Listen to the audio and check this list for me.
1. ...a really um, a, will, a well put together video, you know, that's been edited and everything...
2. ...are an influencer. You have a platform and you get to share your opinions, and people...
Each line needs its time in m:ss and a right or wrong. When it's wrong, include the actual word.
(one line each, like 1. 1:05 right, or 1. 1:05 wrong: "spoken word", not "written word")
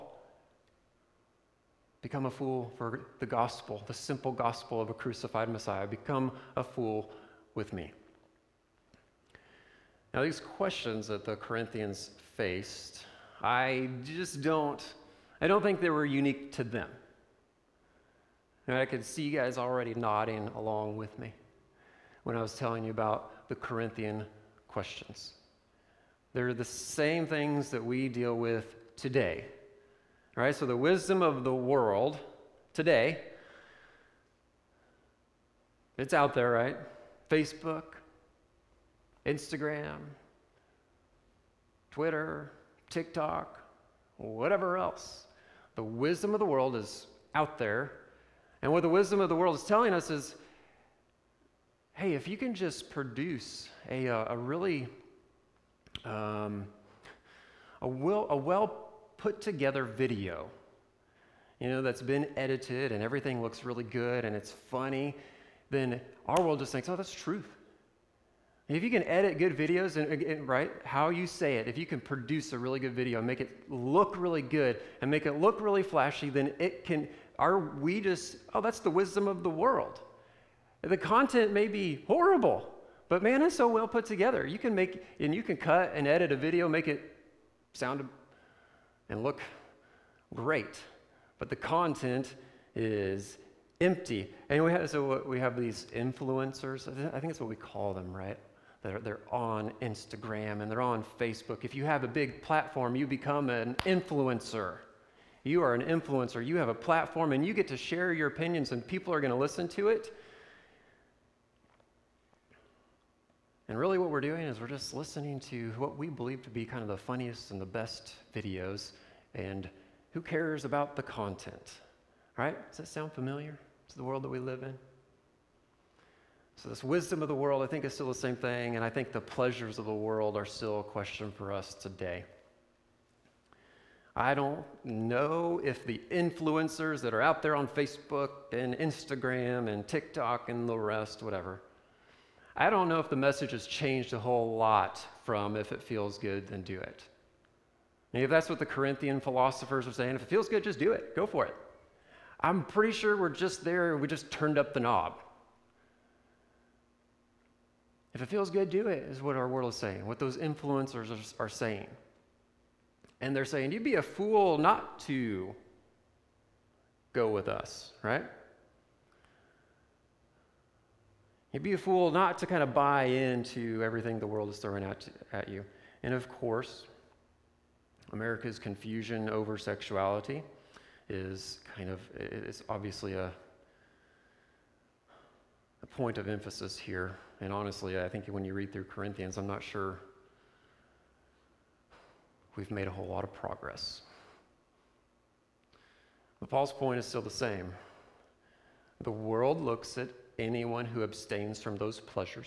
1. 0:54 right
2. 1:45 right.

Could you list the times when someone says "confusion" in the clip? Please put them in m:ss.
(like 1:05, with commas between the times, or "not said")
2:58.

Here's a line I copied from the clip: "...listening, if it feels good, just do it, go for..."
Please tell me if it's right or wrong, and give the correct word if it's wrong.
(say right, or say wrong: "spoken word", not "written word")
wrong: "saying", not "listening".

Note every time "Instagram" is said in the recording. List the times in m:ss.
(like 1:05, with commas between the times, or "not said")
0:39, 1:39, 2:18.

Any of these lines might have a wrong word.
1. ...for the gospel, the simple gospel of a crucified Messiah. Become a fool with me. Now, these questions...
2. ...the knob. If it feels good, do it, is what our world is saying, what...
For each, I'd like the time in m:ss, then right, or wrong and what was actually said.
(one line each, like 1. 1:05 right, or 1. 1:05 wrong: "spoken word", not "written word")
1. 0:02 right
2. 2:34 right.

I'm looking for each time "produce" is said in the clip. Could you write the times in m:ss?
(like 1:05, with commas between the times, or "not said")
0:52, 1:12.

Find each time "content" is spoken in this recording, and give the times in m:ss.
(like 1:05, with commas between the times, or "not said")
1:20, 1:31, 2:01.